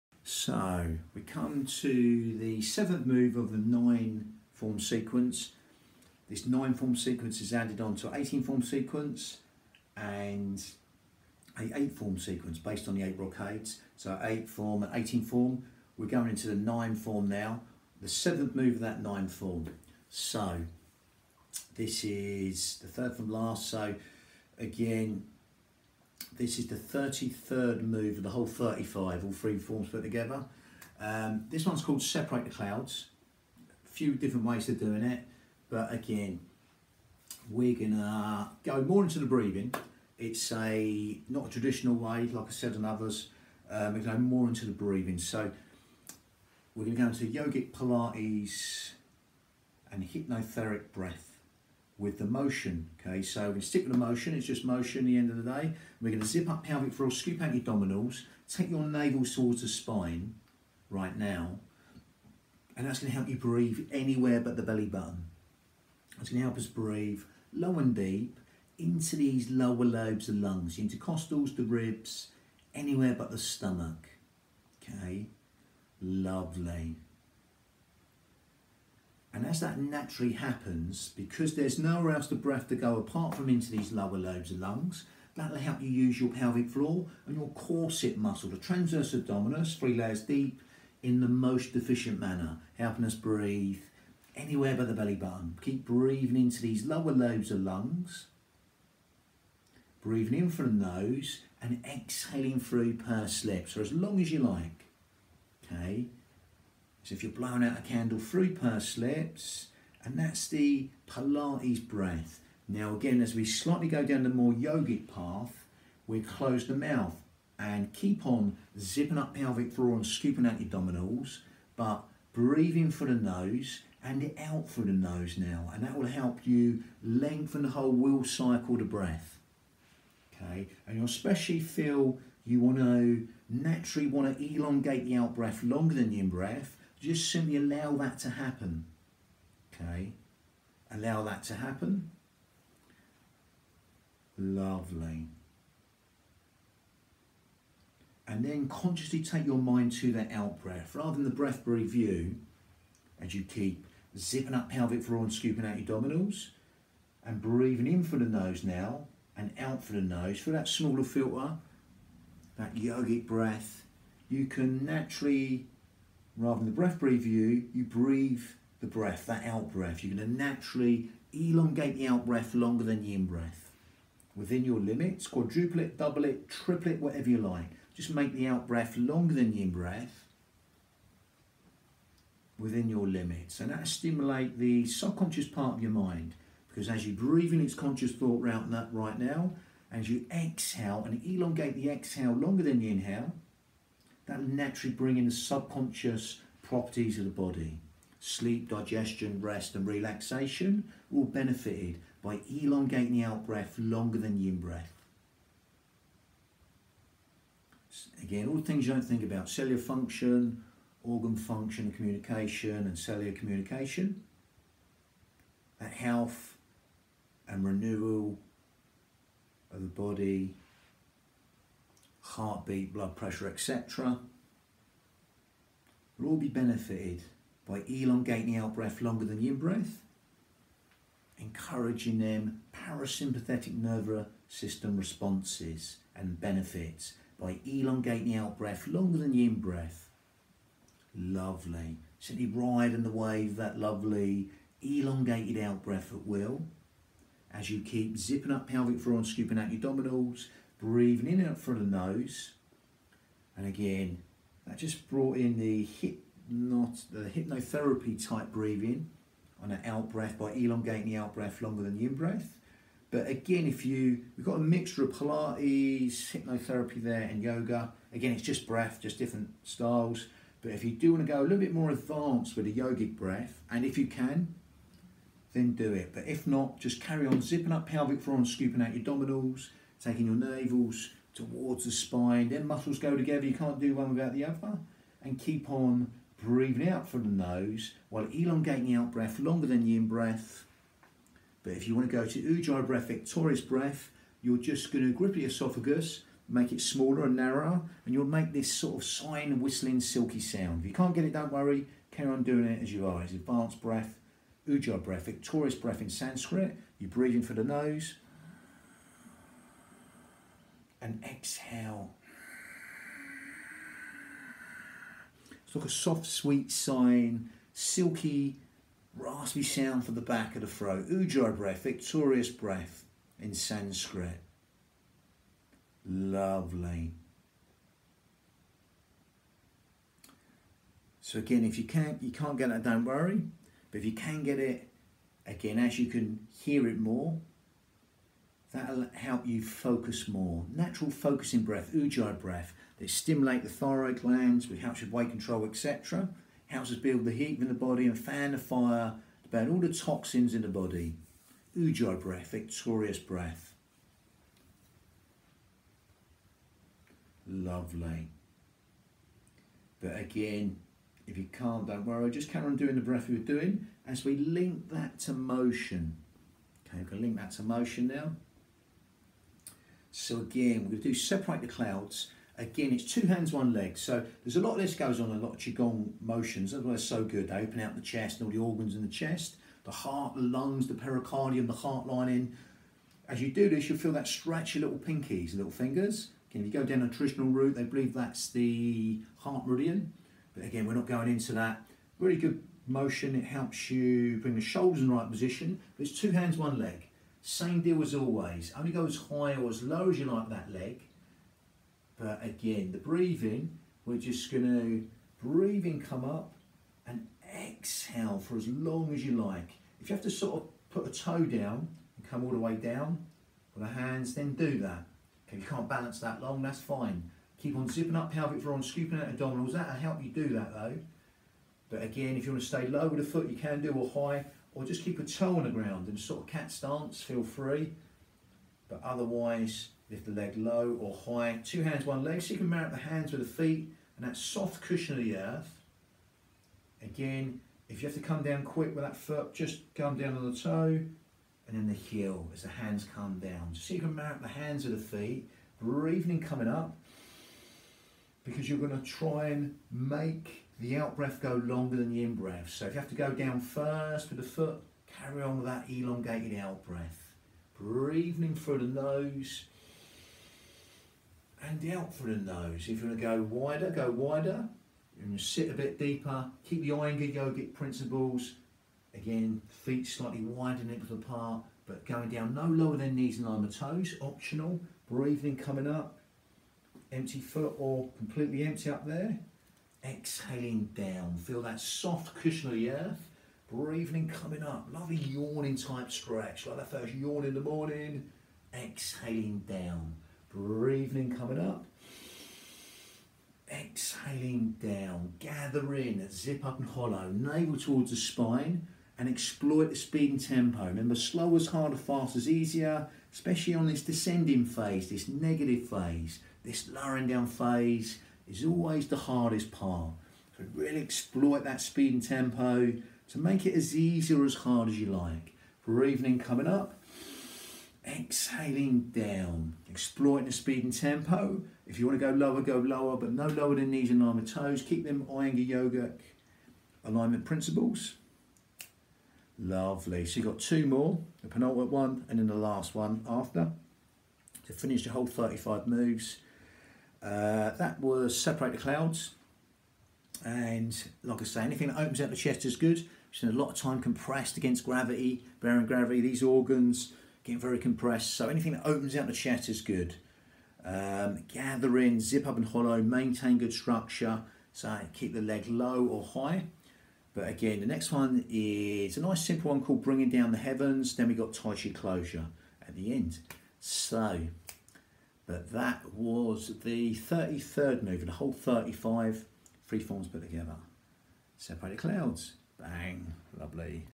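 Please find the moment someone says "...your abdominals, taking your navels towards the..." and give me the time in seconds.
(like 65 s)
278 s.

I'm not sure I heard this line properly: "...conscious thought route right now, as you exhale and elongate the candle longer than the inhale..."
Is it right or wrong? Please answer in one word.
wrong.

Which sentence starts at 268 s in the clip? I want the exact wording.
Again, it's just breath, just different styles.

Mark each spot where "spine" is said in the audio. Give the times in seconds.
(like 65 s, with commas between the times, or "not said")
59 s, 281 s, 498 s.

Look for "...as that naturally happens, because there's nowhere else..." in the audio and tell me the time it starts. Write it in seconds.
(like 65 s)
79 s.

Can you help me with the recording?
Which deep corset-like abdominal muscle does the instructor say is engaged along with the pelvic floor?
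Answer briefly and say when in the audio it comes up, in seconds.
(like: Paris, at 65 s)
transverse abdominis, at 88 s.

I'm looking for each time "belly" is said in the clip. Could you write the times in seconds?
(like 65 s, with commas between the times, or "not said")
64 s, 94 s.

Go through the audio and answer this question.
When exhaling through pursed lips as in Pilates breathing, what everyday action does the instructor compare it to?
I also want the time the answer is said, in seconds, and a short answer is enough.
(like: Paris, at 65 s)
blowing out a candle, at 107 s.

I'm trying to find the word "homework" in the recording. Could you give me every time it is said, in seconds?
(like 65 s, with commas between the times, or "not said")
not said.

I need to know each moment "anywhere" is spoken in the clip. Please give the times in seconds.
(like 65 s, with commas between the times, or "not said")
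63 s, 72 s, 94 s.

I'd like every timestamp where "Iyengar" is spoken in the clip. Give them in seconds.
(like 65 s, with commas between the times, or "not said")
466 s, 525 s.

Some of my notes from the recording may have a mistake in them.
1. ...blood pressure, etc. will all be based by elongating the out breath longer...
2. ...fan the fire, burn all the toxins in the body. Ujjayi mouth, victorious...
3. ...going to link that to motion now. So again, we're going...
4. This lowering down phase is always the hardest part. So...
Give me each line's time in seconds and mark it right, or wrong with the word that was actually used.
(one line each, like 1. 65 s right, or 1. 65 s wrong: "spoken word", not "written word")
1. 222 s wrong: "benefited", not "based"
2. 348 s wrong: "breath", not "mouth"
3. 367 s right
4. 506 s right.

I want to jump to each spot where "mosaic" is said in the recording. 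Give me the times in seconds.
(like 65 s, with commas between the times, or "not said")
not said.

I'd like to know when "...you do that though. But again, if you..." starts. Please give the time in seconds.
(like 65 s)
420 s.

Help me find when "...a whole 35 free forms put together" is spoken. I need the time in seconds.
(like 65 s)
568 s.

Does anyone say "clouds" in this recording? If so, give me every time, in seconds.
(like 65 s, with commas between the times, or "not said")
32 s, 371 s, 538 s, 571 s.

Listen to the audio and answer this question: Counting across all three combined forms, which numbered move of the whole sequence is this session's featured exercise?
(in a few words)
33rd.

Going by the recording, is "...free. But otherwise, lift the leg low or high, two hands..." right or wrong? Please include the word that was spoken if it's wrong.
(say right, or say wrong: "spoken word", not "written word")
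right.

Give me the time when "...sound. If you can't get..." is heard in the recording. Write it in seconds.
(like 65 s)
300 s.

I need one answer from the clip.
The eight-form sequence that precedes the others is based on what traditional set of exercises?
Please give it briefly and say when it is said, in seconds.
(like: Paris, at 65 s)
the eight brocades, at 12 s.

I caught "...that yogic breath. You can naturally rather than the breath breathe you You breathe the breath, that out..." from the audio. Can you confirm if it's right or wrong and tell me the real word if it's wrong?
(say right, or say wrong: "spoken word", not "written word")
right.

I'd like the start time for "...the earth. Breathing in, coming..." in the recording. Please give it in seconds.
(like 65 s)
482 s.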